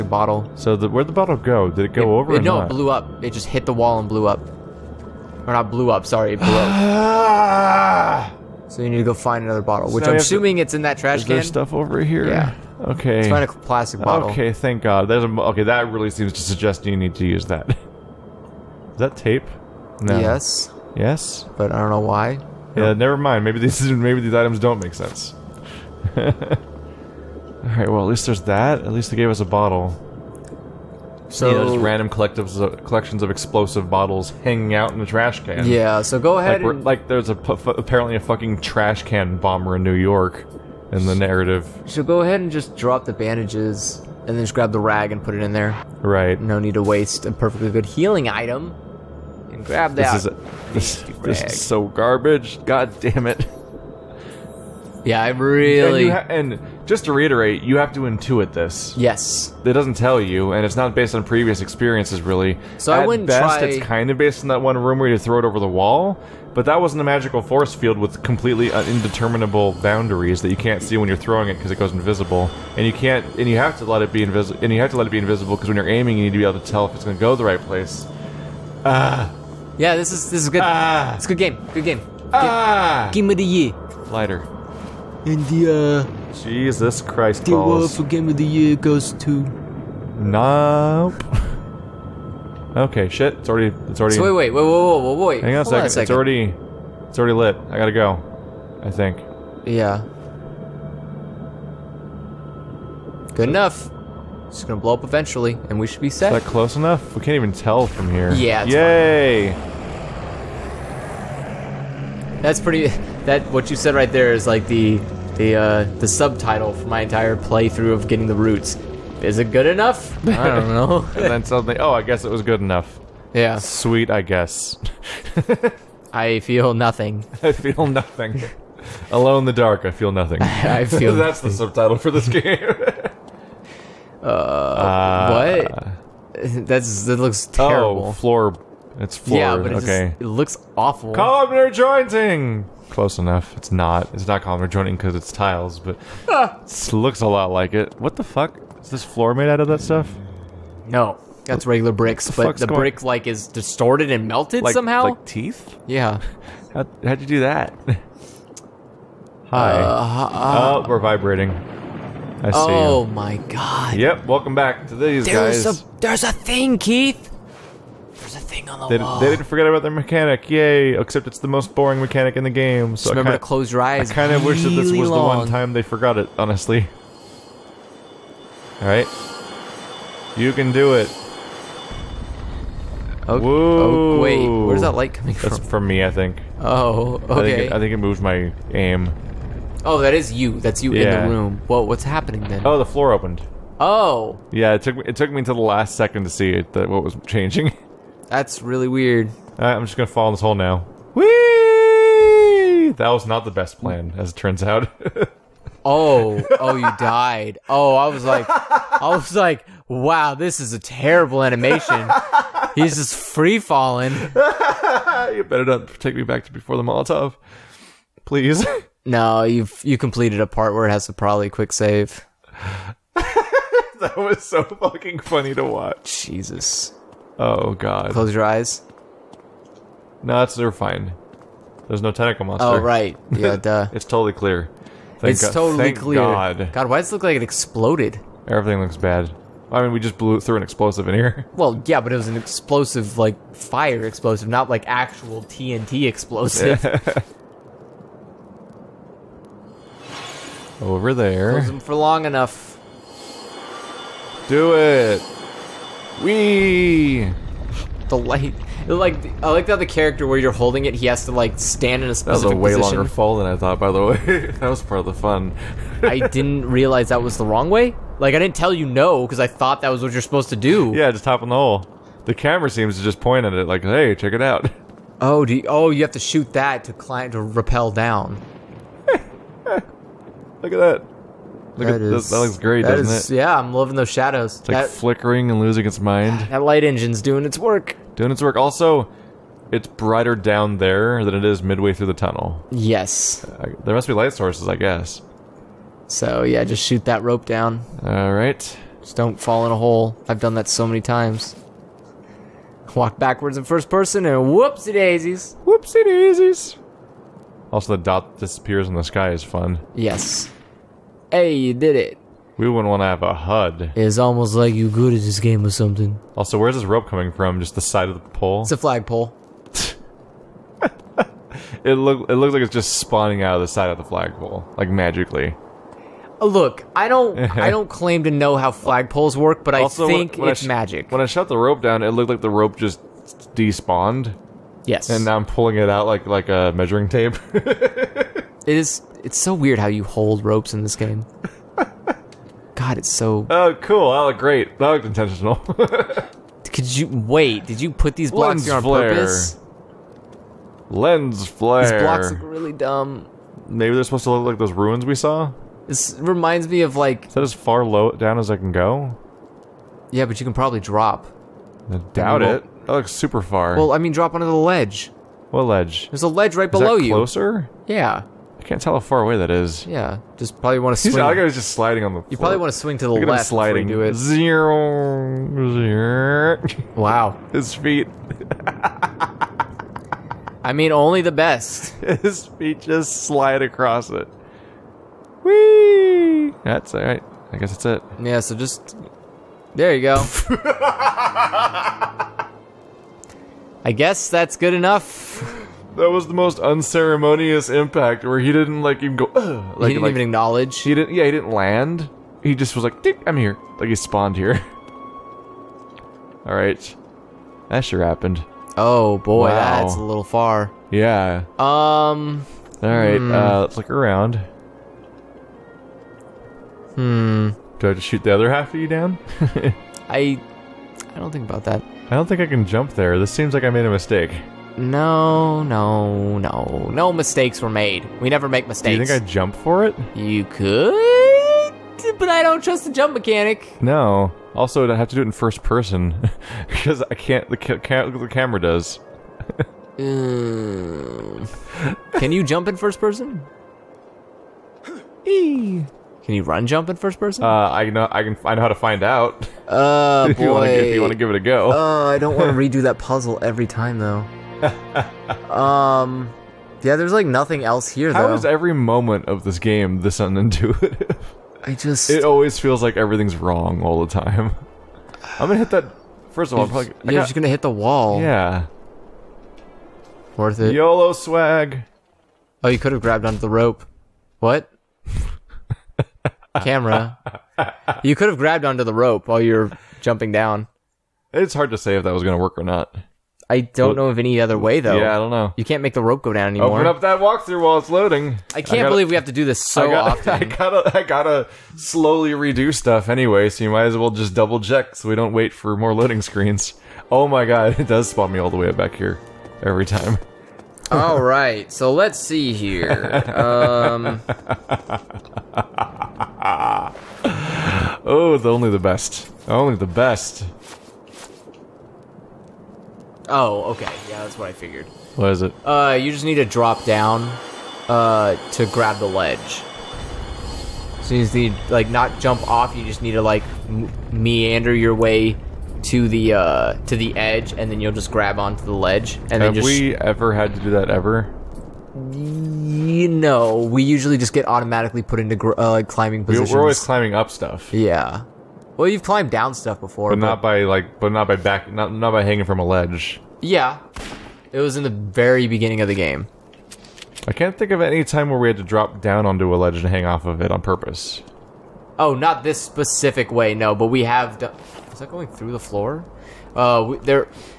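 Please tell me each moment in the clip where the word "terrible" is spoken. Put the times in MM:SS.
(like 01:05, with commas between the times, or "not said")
02:17, 03:30.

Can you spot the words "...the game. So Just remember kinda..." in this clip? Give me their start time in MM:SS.
02:52.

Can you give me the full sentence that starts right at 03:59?
I mean, we just blew through an explosive in here.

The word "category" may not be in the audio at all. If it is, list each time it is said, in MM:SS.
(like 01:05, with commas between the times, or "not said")
not said.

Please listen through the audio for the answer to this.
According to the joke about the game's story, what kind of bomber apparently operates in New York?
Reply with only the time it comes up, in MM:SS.
00:38.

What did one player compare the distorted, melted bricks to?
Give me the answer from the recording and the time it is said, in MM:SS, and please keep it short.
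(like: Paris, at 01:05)
teeth, at 02:35.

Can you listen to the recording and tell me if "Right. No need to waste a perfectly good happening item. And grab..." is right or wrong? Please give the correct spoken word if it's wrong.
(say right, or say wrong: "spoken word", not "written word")
wrong: "healing", not "happening".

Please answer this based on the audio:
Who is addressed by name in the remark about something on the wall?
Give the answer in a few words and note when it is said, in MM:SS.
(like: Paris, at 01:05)
Keith, at 02:46.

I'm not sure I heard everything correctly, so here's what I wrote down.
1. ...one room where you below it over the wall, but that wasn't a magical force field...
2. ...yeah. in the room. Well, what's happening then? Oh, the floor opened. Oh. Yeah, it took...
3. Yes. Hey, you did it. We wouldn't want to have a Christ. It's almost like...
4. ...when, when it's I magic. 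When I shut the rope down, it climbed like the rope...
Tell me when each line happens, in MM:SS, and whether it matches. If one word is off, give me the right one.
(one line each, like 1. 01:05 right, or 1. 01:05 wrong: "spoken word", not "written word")
1. 01:04 wrong: "throw", not "below"
2. 03:10 right
3. 05:09 wrong: "HUD", not "Christ"
4. 05:30 wrong: "looked", not "climbed".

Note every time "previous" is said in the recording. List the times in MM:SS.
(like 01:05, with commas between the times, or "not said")
01:01.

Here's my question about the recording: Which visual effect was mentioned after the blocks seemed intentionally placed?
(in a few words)
Lens flare.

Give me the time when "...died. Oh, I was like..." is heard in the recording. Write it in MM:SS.
03:26.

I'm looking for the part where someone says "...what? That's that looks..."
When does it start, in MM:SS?
02:16.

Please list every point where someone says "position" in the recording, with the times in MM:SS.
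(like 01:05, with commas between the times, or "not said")
04:22, 08:56.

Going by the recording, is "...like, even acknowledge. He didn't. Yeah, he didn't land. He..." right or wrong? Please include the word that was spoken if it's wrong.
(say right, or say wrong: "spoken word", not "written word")
right.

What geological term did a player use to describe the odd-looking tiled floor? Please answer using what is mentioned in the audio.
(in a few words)
Columnar jointing.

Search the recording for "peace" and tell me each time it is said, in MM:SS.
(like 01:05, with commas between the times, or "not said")
not said.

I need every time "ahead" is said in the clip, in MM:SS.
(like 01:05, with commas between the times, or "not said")
00:36, 00:42.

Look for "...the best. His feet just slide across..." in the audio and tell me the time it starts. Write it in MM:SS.
06:21.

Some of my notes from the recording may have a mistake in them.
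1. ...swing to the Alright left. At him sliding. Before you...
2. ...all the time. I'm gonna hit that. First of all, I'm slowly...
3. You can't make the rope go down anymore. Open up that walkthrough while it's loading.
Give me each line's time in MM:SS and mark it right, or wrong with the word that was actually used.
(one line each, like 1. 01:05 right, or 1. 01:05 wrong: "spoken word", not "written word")
1. 06:12 wrong: "Look", not "Alright"
2. 07:43 wrong: "probably", not "slowly"
3. 08:05 right.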